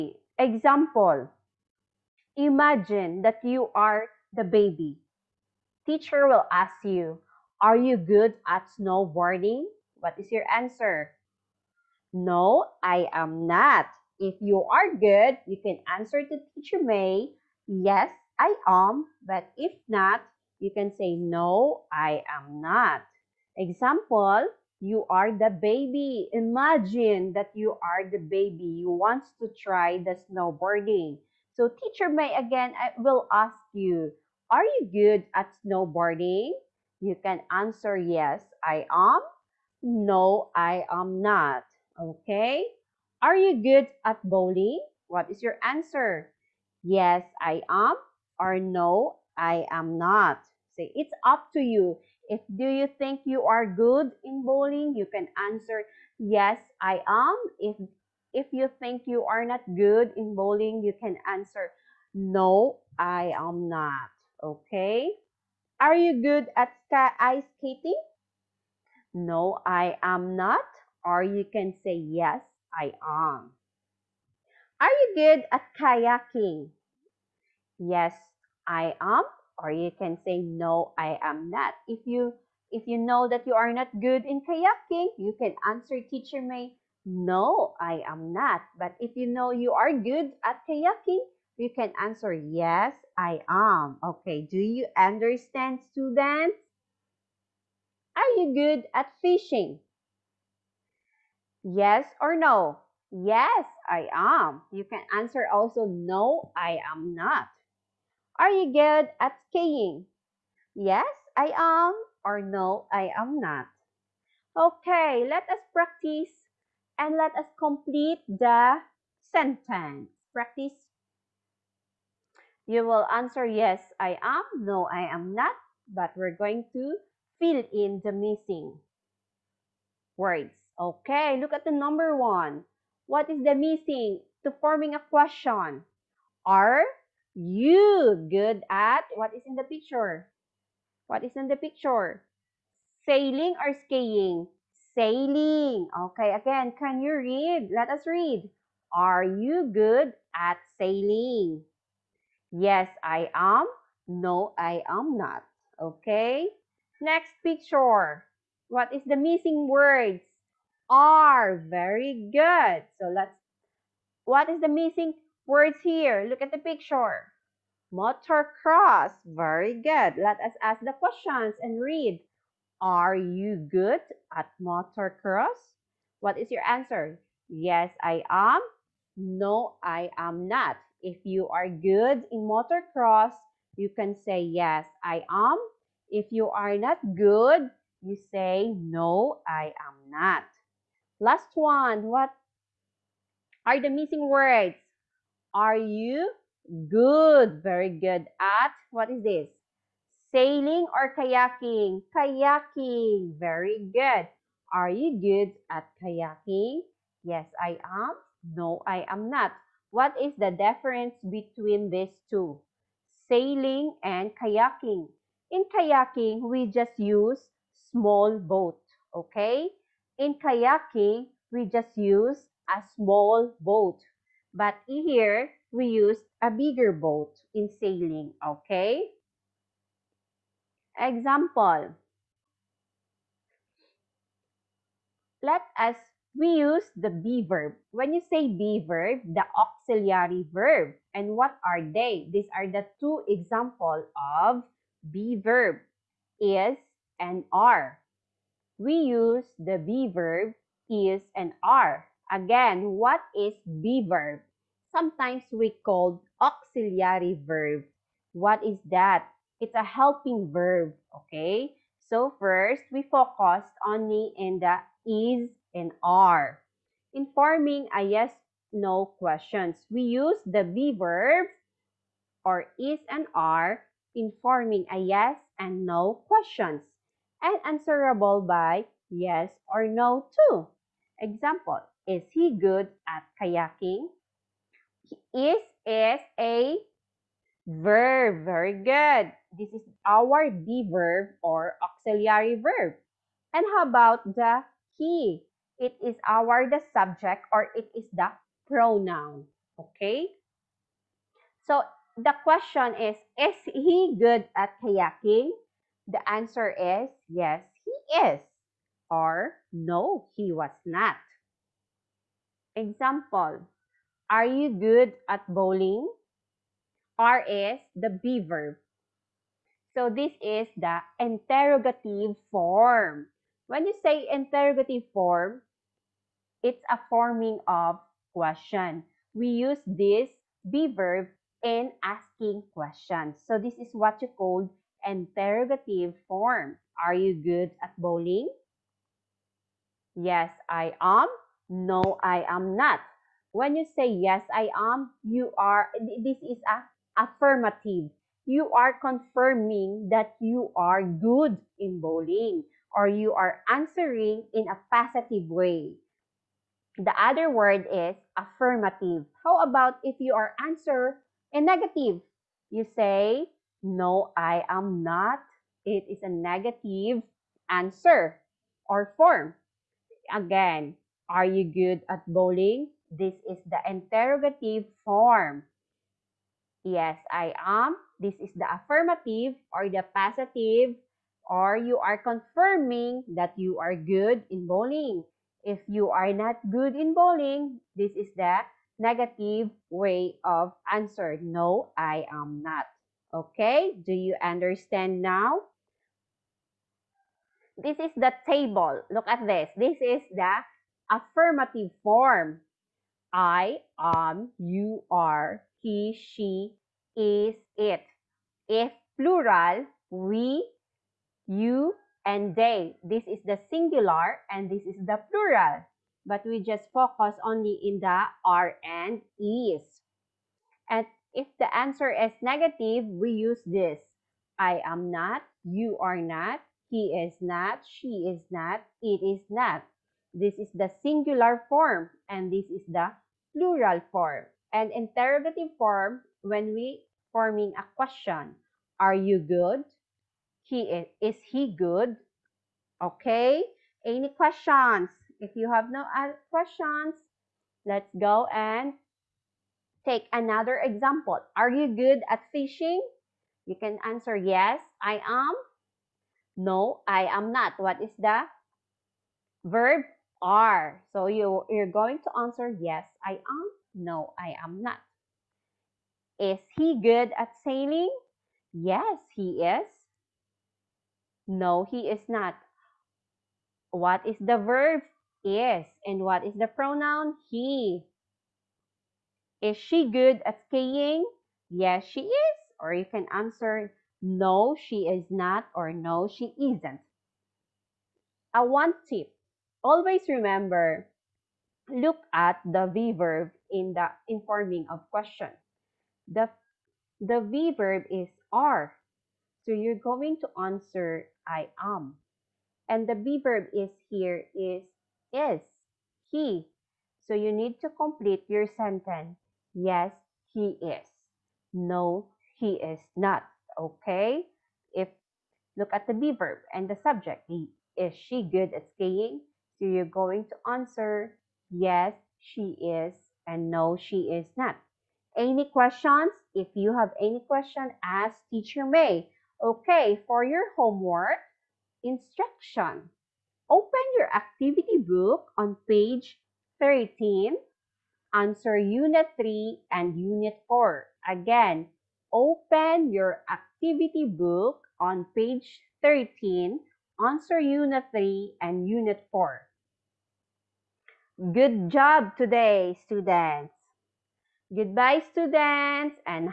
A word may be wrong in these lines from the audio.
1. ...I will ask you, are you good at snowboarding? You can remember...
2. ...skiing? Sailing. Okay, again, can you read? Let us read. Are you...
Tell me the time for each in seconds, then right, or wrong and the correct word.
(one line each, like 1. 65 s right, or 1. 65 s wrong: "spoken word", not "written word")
1. 32 s wrong: "answer", not "remember"
2. 143 s right.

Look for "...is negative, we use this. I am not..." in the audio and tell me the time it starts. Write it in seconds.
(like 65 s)
422 s.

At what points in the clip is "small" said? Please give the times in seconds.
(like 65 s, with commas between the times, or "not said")
217 s, 222 s.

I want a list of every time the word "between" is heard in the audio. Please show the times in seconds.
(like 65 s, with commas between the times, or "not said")
211 s.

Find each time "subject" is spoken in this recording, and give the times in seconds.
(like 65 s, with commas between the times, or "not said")
296 s, 517 s.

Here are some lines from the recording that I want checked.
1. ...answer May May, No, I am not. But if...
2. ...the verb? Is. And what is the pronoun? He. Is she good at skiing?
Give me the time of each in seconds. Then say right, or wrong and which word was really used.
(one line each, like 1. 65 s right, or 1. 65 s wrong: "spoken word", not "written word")
1. 85 s wrong: "Teacher", not "May"
2. 474 s right.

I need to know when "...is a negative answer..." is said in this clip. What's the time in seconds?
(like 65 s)
366 s.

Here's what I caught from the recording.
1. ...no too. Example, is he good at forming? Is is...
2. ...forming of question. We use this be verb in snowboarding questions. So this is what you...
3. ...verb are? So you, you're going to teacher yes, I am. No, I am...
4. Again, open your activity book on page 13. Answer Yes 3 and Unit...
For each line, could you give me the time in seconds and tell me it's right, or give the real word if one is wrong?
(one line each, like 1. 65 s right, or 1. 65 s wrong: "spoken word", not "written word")
1. 279 s wrong: "kayaking", not "forming"
2. 327 s wrong: "asking", not "snowboarding"
3. 459 s wrong: "answer", not "teacher"
4. 541 s wrong: "Unit", not "Yes".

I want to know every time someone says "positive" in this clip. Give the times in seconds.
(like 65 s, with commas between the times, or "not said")
354 s, 380 s.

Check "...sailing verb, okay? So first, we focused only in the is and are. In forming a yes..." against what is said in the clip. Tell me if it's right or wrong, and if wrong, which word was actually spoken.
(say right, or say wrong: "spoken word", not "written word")
wrong: "helping", not "sailing".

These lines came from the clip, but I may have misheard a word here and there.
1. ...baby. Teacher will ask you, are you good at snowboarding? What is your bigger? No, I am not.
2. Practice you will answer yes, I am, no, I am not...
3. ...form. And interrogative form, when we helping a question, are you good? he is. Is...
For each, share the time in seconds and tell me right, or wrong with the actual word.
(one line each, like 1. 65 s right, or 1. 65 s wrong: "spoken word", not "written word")
1. 4 s wrong: "answer", not "bigger"
2. 120 s right
3. 434 s wrong: "forming", not "helping".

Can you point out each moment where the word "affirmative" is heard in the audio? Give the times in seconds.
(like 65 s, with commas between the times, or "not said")
347 s, 358 s, 378 s, 401 s.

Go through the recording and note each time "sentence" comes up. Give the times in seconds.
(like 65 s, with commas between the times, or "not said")
119 s, 508 s.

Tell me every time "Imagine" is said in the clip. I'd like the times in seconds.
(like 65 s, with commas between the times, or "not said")
2 s, 26 s.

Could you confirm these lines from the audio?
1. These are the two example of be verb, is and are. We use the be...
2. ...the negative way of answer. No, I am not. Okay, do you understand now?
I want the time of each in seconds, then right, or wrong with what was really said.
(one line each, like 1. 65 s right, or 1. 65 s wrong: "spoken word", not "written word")
1. 242 s right
2. 388 s right.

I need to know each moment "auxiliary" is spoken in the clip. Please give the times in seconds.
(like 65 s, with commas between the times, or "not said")
239 s, 256 s, 291 s.